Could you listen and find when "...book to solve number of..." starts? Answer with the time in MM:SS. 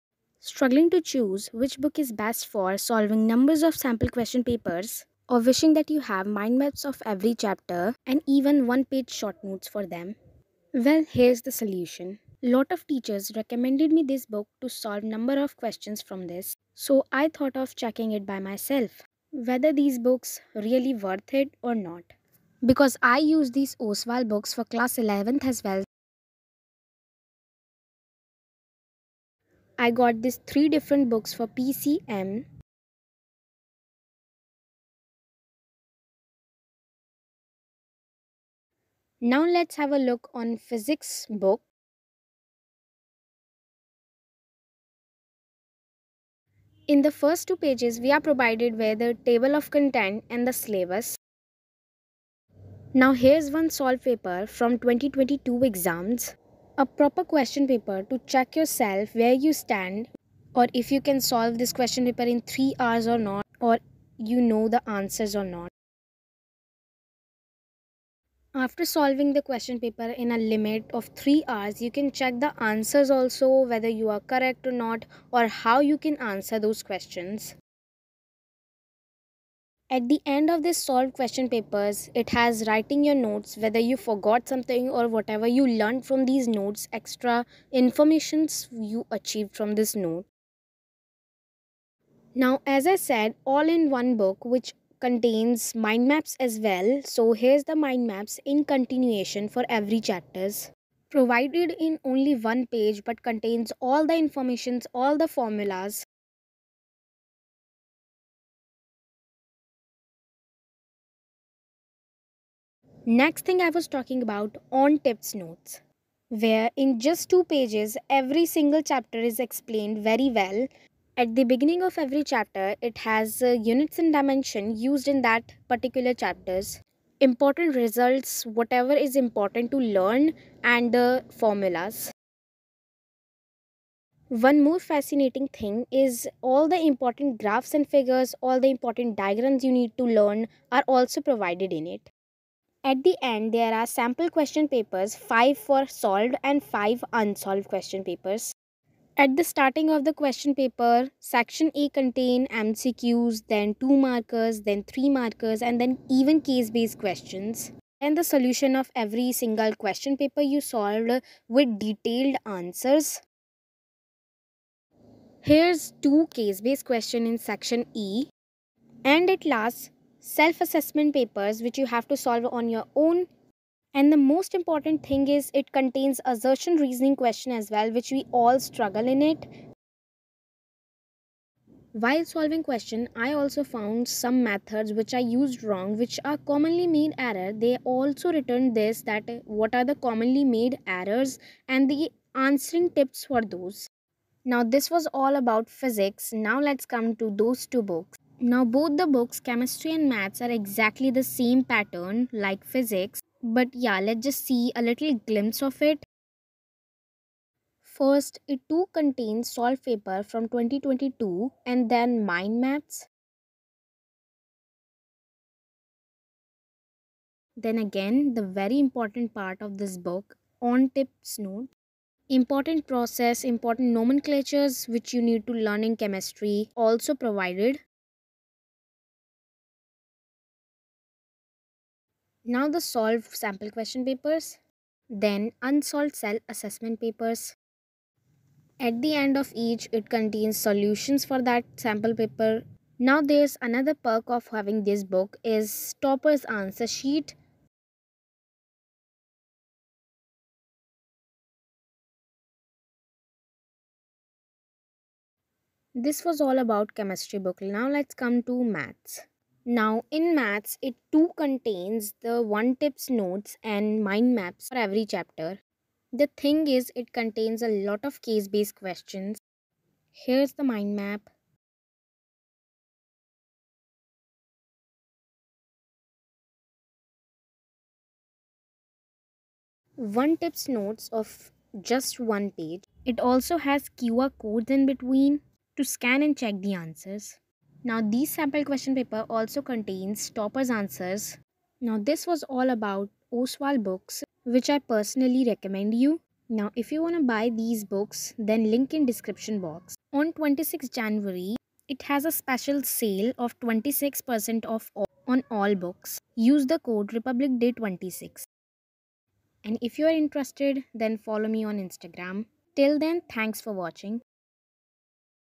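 00:14.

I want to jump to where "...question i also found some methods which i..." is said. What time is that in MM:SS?
03:02.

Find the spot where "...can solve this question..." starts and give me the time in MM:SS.
01:01.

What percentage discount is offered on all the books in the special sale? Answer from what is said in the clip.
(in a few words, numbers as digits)
26%.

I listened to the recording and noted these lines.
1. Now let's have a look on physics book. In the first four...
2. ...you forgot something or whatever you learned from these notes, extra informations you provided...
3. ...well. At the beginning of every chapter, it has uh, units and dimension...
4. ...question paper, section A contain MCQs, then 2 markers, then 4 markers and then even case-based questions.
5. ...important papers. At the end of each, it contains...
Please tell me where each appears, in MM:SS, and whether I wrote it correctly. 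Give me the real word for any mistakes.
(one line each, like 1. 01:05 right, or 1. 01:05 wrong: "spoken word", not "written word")
1. 00:39 wrong: "two", not "four"
2. 01:23 wrong: "achieved", not "provided"
3. 02:00 right
4. 02:30 wrong: "3", not "4"
5. 03:56 wrong: "assessment", not "important".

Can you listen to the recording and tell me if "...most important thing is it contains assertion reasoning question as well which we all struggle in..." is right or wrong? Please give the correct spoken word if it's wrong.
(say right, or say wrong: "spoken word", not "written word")
right.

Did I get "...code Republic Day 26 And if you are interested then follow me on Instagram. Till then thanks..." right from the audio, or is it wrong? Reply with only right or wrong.
right.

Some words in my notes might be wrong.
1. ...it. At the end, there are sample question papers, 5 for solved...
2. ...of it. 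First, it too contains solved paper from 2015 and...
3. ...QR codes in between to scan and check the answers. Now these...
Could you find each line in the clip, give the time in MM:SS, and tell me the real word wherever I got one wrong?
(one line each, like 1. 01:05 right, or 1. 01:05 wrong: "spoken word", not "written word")
1. 02:21 right
2. 03:25 wrong: "2022", not "2015"
3. 04:43 right.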